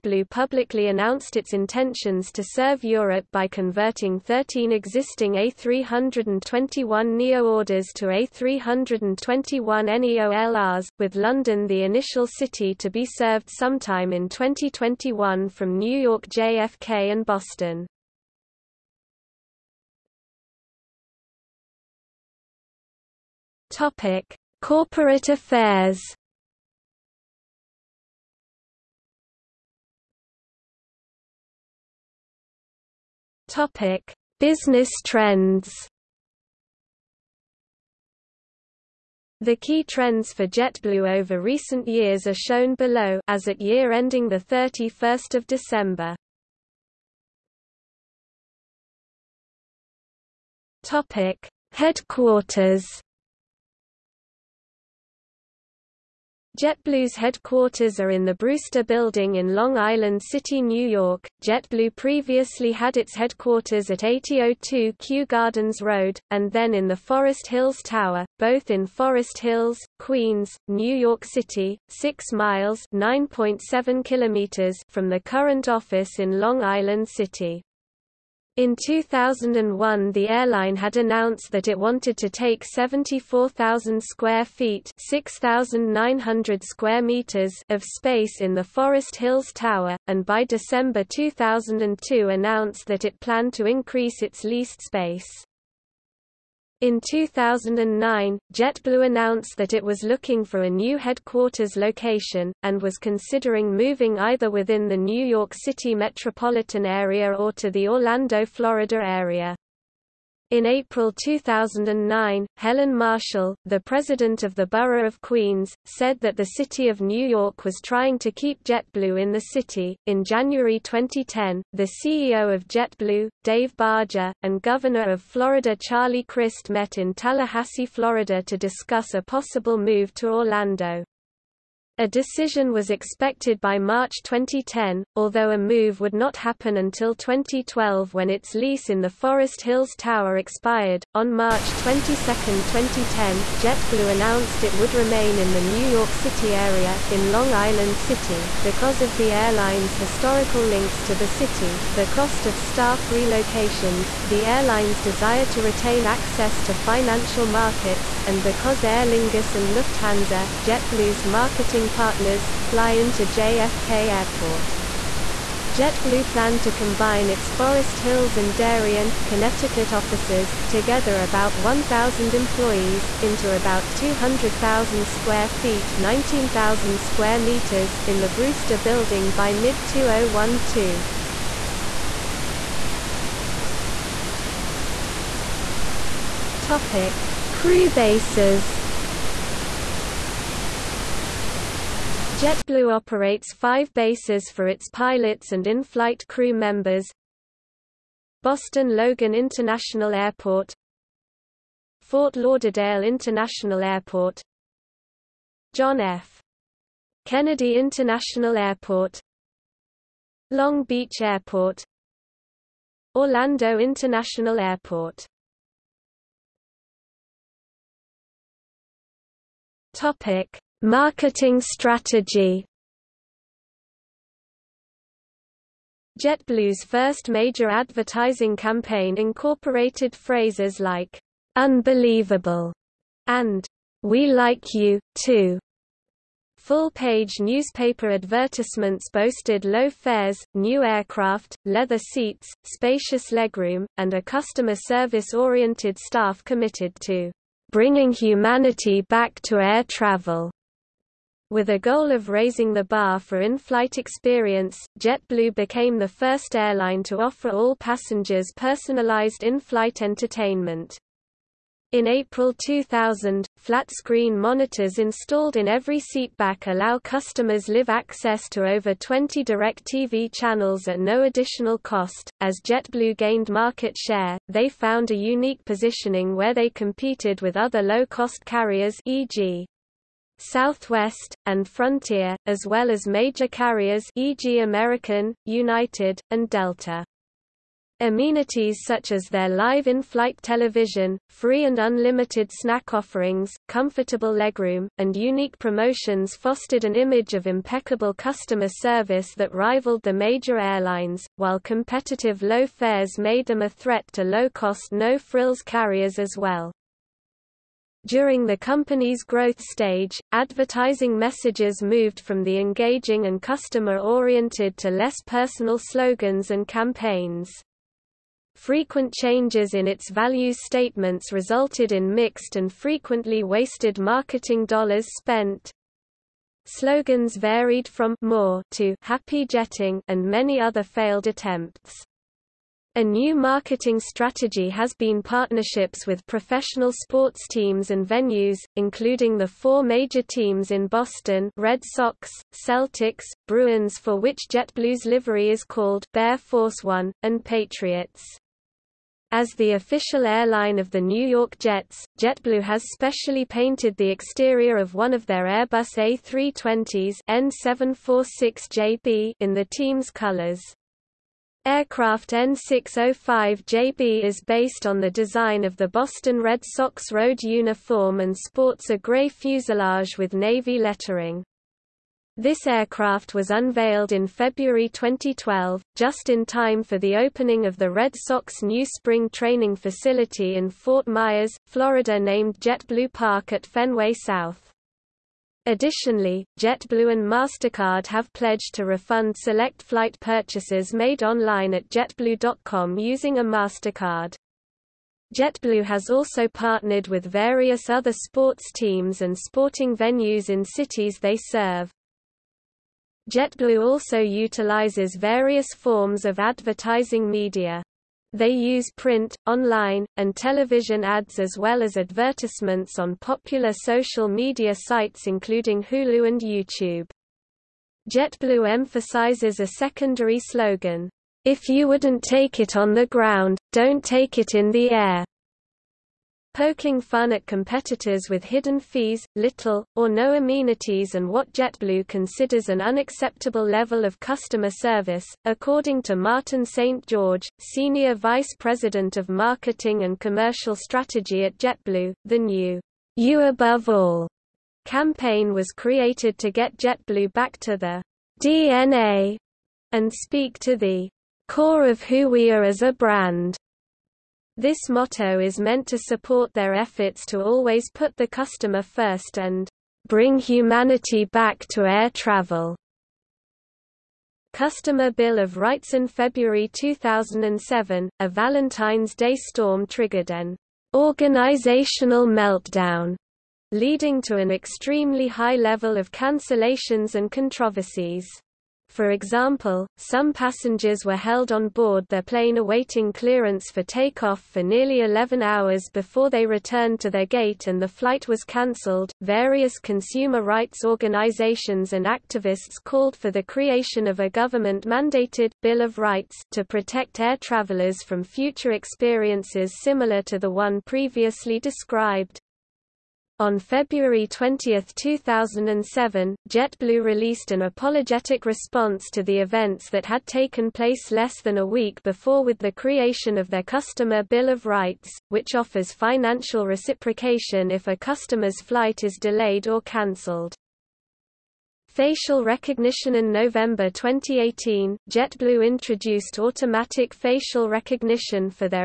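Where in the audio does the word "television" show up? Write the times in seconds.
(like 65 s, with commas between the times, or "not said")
290 s, 410 s.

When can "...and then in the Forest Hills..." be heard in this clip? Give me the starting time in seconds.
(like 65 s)
66 s.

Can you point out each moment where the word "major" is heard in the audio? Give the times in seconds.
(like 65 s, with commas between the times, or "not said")
227 s, 283 s, 300 s, 339 s.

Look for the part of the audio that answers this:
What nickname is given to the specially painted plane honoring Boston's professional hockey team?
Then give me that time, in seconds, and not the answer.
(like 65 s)
346 s.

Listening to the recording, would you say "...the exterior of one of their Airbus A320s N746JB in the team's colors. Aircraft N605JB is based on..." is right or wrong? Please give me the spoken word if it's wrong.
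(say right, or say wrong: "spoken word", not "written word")
right.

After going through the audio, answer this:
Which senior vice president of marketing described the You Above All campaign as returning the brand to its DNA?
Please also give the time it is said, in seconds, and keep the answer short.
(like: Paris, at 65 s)
Martin St. George, at 436 s.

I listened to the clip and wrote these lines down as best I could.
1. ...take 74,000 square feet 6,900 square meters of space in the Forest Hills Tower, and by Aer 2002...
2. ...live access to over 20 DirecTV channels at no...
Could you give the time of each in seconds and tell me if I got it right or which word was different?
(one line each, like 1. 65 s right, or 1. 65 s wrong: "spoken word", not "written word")
1. 82 s wrong: "December", not "Aer"
2. 267 s right.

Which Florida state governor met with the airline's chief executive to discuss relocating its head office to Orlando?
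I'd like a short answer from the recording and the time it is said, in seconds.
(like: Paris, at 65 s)
Charlie Crist, at 125 s.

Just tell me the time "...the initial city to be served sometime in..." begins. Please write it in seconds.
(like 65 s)
11 s.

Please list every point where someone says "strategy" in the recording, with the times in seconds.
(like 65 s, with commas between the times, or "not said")
221 s, 333 s, 440 s.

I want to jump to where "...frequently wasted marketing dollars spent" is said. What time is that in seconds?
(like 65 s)
322 s.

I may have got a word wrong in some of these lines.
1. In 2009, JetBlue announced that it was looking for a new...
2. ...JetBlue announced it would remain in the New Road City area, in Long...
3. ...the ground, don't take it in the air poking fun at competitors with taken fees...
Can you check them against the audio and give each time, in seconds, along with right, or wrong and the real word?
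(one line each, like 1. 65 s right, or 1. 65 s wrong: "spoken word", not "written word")
1. 96 s right
2. 143 s wrong: "York", not "Road"
3. 422 s wrong: "hidden", not "taken".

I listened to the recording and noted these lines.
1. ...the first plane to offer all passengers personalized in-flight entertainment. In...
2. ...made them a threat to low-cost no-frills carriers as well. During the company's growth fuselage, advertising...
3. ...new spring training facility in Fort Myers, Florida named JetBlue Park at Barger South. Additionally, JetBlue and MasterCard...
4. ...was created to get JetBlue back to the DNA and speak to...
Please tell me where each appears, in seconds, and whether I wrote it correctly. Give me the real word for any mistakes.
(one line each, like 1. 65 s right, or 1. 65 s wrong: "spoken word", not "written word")
1. 255 s wrong: "airline", not "plane"
2. 303 s wrong: "stage", not "fuselage"
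3. 378 s wrong: "Fenway", not "Barger"
4. 445 s right.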